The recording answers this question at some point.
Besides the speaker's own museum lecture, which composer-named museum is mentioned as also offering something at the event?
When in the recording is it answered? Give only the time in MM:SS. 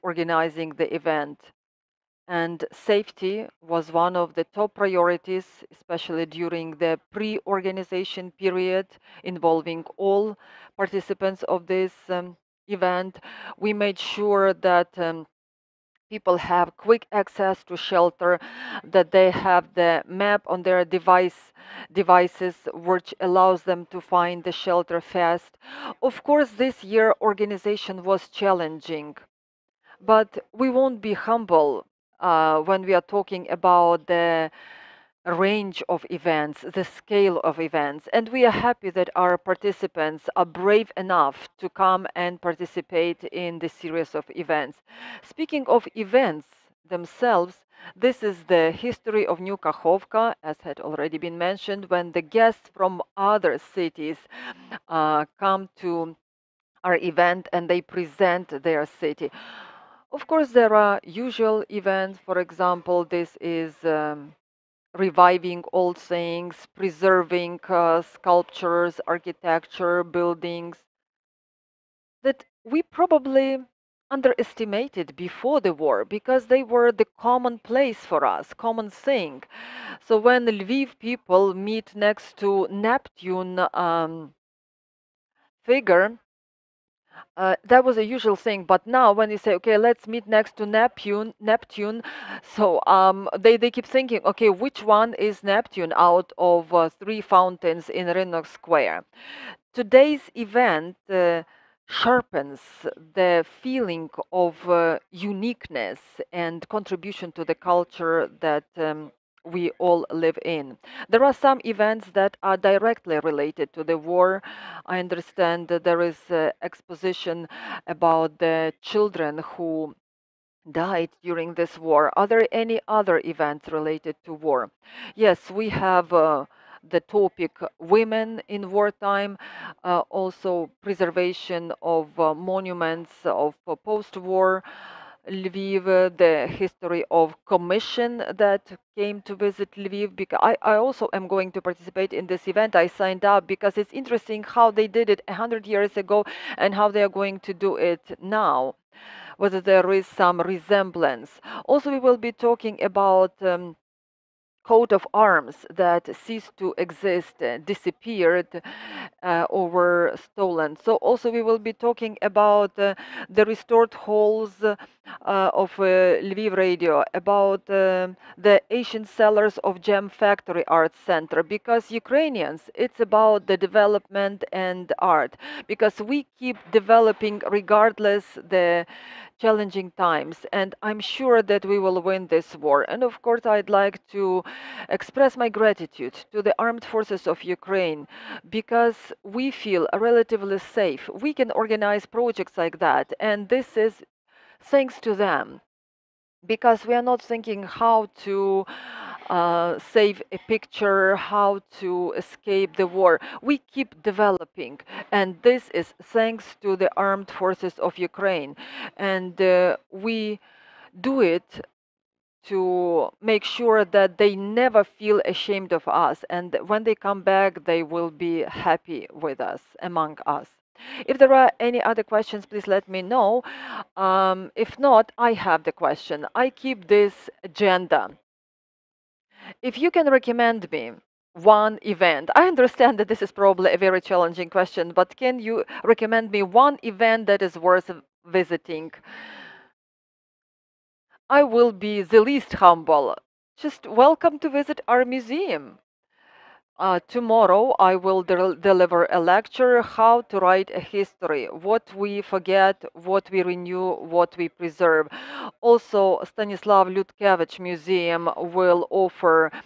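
04:16.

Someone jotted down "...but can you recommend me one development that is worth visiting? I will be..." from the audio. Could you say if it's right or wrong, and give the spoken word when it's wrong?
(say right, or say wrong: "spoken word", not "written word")
wrong: "event", not "development".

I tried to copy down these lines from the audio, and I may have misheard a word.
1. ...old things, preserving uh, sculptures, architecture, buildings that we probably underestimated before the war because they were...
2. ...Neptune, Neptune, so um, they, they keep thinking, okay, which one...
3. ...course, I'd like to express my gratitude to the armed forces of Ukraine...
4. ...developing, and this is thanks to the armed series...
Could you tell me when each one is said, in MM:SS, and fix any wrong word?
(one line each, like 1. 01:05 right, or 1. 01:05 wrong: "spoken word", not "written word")
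1. 01:05 right
2. 01:30 right
3. 03:03 right
4. 03:24 wrong: "forces", not "series".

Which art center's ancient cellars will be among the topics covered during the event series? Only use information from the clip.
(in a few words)
Jam Factory Art Center.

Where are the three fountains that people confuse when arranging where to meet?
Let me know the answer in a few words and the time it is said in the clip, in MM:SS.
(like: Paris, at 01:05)
Rynok Square, at 01:38.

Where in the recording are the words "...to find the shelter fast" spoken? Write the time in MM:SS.
00:23.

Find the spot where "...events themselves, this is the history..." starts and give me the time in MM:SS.
00:45.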